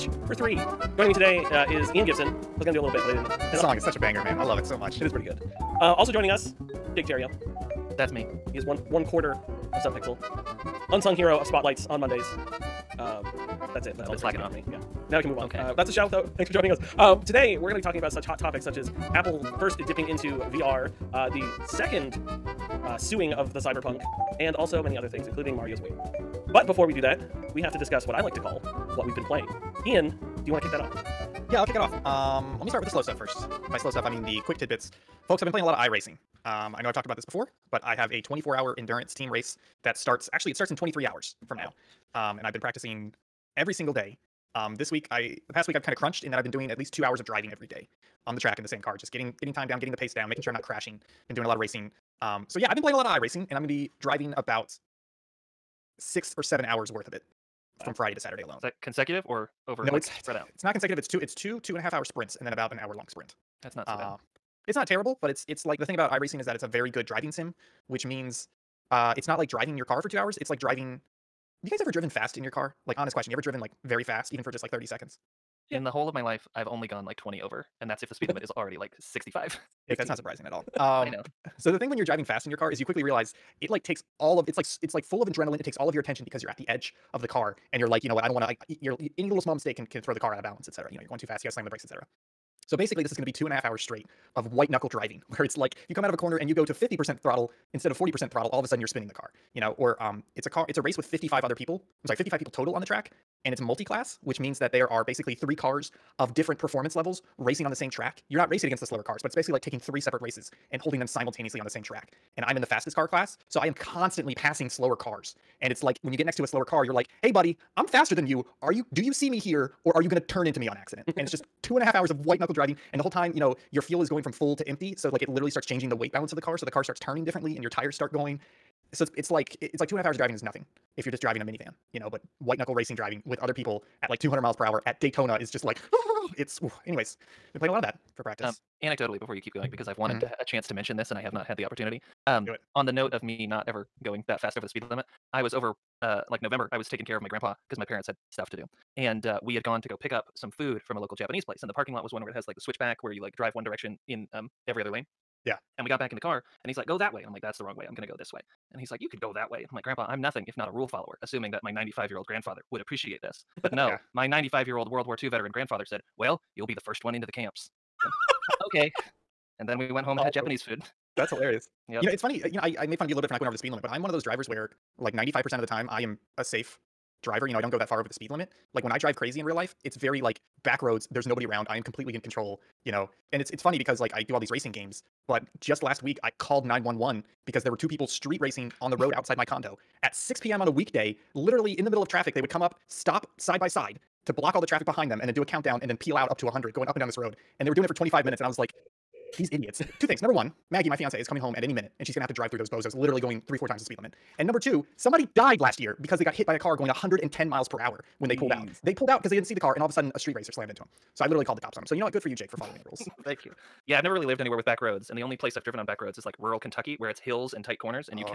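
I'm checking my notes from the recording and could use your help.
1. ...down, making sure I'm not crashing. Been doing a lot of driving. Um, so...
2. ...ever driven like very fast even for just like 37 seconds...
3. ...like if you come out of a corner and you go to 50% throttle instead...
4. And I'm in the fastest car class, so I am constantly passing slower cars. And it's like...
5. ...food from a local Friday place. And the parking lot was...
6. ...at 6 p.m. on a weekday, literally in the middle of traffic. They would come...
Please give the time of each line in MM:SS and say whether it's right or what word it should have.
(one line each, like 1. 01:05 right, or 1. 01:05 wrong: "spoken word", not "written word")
1. 00:50 wrong: "racing", not "driving"
2. 01:13 wrong: "30", not "37"
3. 01:35 right
4. 01:52 right
5. 02:30 wrong: "Japanese", not "Friday"
6. 03:10 right.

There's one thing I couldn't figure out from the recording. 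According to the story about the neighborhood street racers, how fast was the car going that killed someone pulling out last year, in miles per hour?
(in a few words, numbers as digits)
110.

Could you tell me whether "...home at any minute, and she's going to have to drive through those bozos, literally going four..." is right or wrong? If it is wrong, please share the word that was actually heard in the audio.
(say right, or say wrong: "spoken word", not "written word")
wrong: "three", not "four".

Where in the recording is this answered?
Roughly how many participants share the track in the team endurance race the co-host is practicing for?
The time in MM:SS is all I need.
01:42.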